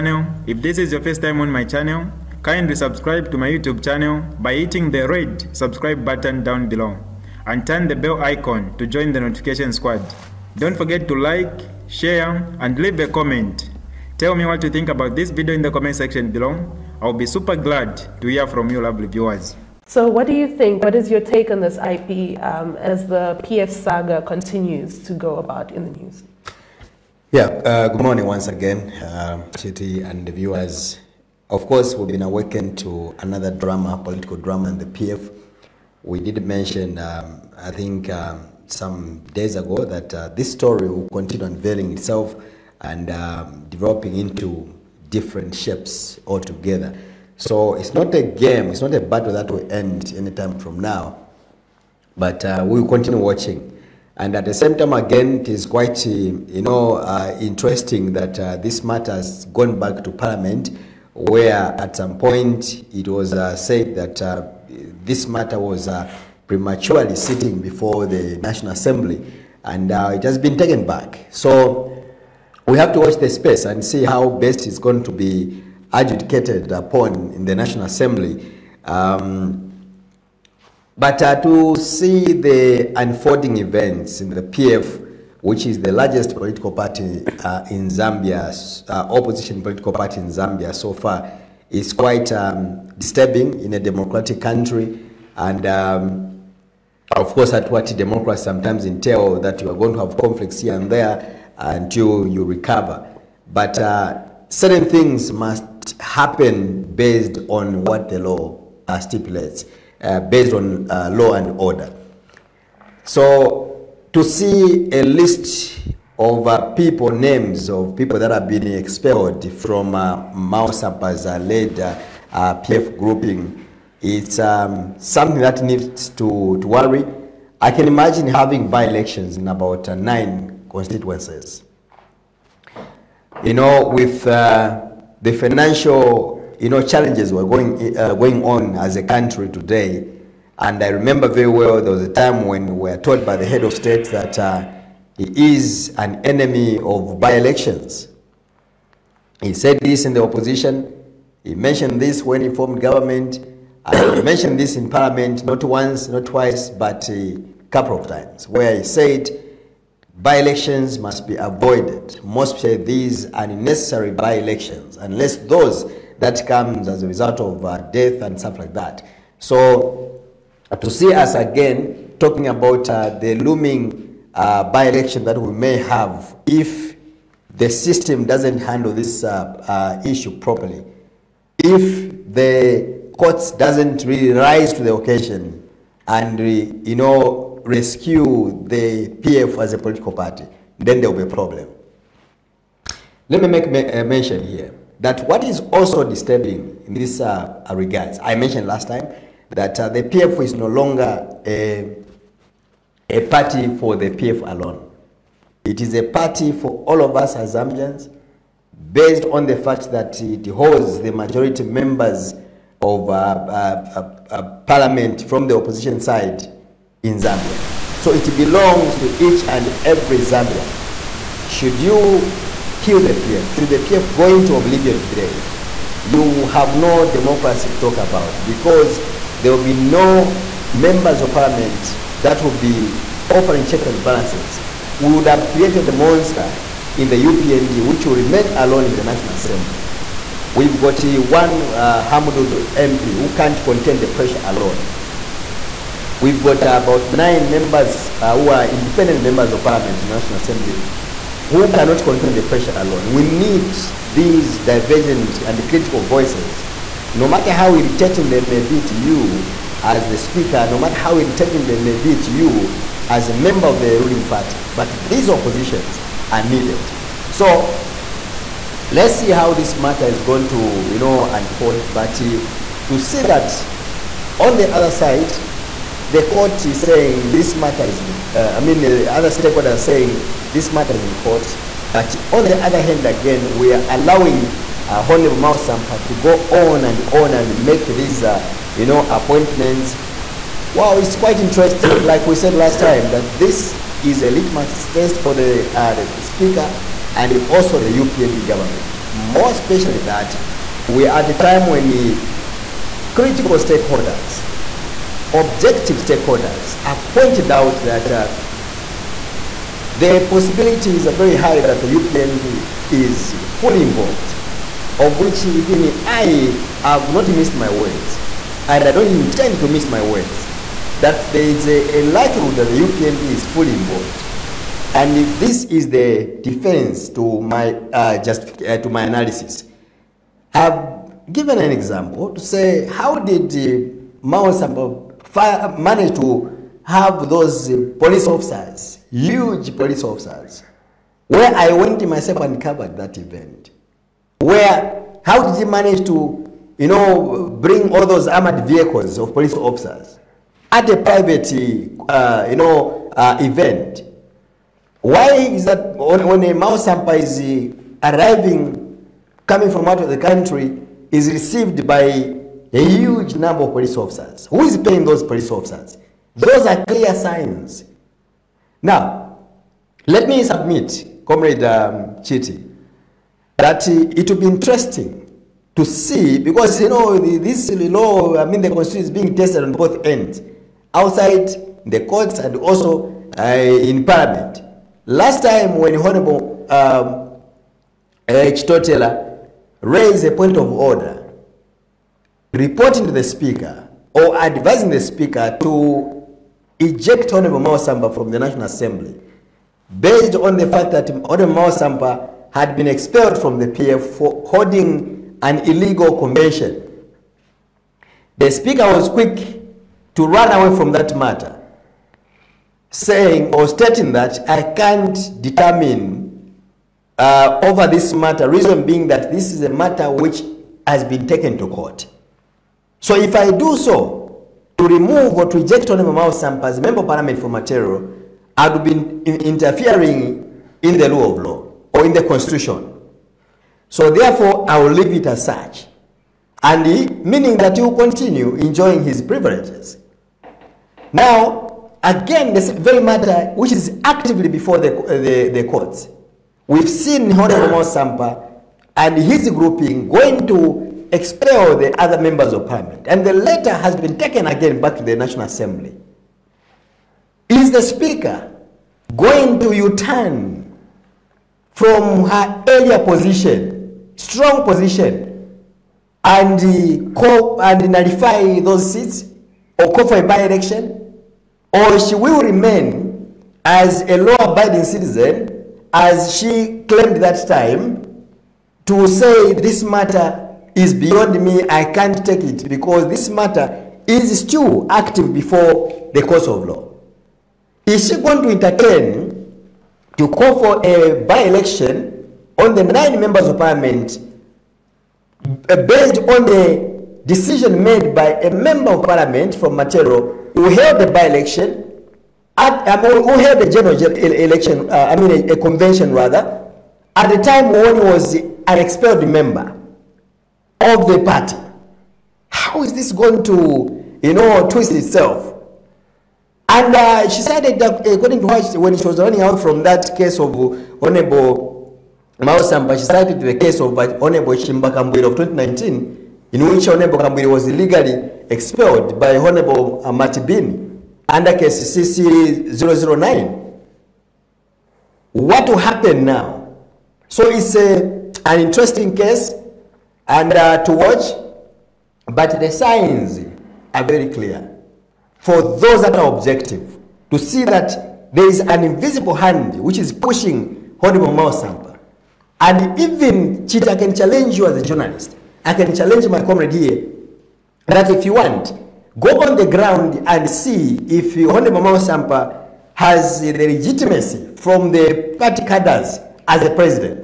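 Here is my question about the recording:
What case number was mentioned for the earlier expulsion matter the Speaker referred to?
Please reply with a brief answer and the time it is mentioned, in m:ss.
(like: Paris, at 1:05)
CC009, at 8:51.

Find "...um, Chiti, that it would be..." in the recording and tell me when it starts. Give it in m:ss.
6:11.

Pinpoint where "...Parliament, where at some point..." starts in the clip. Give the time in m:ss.
1:00.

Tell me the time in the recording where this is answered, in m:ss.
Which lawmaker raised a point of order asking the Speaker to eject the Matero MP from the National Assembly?
6:28.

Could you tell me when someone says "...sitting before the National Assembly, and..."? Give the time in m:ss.
1:07.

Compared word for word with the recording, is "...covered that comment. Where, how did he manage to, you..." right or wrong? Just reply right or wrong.
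wrong.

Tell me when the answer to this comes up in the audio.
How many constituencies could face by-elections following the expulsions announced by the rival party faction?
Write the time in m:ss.
2:09.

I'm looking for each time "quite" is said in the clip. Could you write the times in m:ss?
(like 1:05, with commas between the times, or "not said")
0:55, 1:31, 4:51.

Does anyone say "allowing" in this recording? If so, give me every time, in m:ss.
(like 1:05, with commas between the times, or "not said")
4:43.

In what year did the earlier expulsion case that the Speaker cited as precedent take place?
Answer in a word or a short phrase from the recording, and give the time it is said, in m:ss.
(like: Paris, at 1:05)
2019, at 8:45.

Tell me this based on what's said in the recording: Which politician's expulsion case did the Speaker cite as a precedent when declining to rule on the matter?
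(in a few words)
Chishimba Kambwili.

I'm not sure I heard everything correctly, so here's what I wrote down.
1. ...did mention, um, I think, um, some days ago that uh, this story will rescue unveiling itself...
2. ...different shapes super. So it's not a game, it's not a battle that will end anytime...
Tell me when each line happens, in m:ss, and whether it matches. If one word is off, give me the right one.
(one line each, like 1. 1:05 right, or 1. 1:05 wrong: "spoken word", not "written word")
1. 0:36 wrong: "continue", not "rescue"
2. 0:45 wrong: "altogether", not "super".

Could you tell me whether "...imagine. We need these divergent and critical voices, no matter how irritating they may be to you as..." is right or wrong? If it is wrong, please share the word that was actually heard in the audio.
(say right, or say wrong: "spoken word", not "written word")
wrong: "alone", not "imagine".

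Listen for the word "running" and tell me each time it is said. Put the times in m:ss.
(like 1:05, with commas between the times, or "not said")
8:39.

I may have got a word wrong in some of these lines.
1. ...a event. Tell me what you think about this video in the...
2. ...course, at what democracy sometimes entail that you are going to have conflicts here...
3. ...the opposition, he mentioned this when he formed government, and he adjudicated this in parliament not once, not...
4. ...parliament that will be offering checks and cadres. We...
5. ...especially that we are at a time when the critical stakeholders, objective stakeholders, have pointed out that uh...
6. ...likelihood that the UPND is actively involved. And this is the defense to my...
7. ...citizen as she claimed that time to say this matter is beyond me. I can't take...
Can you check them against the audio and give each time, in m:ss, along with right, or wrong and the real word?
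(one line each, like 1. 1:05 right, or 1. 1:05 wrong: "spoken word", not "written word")
1. 0:12 wrong: "comment", not "event"
2. 1:37 right
3. 2:30 wrong: "mentioned", not "adjudicated"
4. 3:51 wrong: "balances", not "cadres"
5. 4:59 right
6. 5:22 wrong: "fully", not "actively"
7. 7:54 right.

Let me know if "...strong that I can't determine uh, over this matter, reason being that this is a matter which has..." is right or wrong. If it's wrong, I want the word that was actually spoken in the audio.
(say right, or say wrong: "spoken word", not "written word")
wrong: "stating", not "strong".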